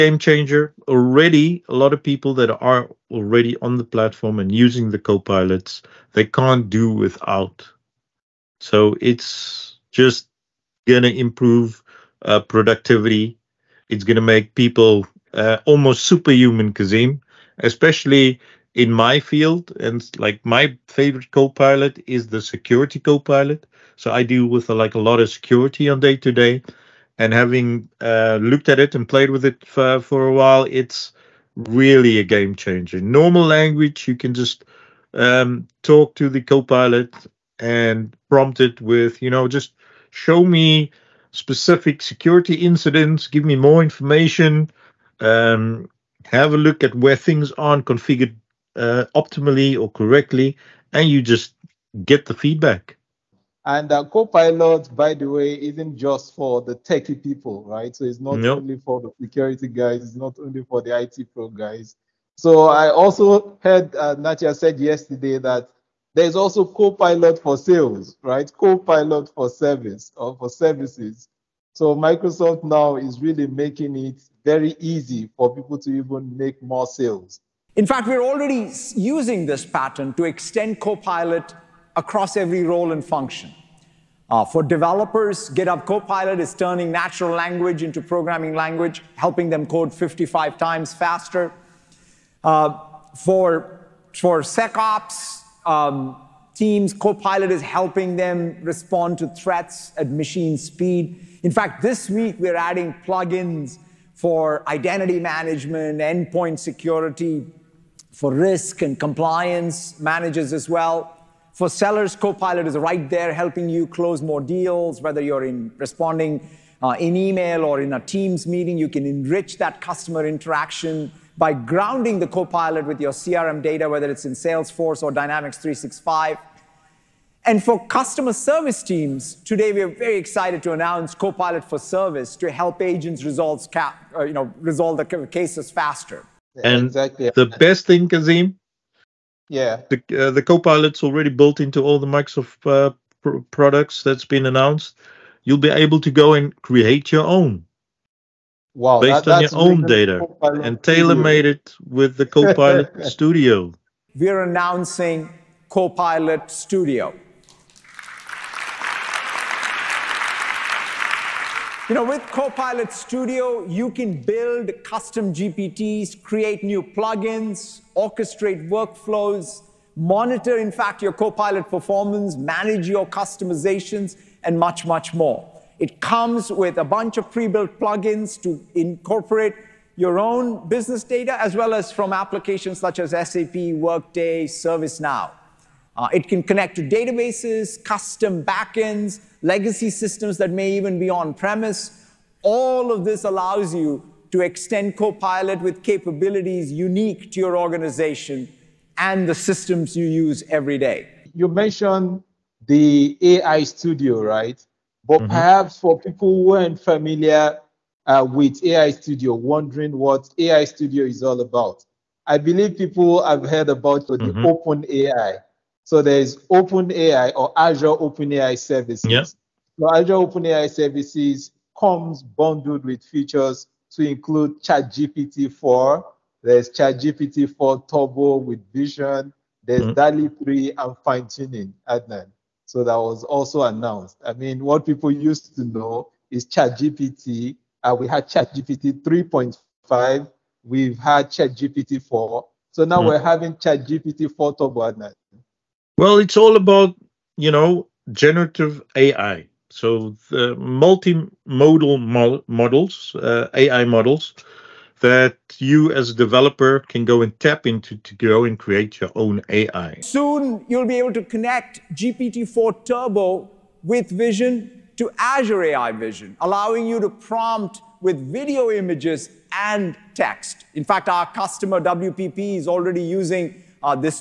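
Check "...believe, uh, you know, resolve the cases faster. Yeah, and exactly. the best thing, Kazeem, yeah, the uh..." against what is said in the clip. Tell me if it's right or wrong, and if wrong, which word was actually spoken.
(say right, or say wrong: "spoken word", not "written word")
wrong: "resolve", not "believe".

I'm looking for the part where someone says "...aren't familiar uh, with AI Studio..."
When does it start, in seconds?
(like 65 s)
206 s.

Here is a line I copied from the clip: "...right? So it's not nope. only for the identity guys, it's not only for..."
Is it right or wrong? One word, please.
wrong.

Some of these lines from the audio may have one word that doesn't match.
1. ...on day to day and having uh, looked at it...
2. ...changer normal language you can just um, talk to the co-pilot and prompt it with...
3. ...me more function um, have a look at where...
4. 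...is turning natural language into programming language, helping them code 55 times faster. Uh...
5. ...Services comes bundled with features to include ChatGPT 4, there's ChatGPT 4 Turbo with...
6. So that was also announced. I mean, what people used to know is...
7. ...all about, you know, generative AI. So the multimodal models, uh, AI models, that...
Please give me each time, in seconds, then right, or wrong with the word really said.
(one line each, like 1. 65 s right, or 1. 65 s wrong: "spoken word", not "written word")
1. 25 s right
2. 32 s right
3. 43 s wrong: "information", not "function"
4. 86 s right
5. 220 s right
6. 232 s right
7. 246 s right.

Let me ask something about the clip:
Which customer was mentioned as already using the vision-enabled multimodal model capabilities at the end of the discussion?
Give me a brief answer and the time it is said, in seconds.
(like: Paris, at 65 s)
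WPP, at 271 s.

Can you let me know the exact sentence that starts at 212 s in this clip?
I believe people have heard about the mm-hmm.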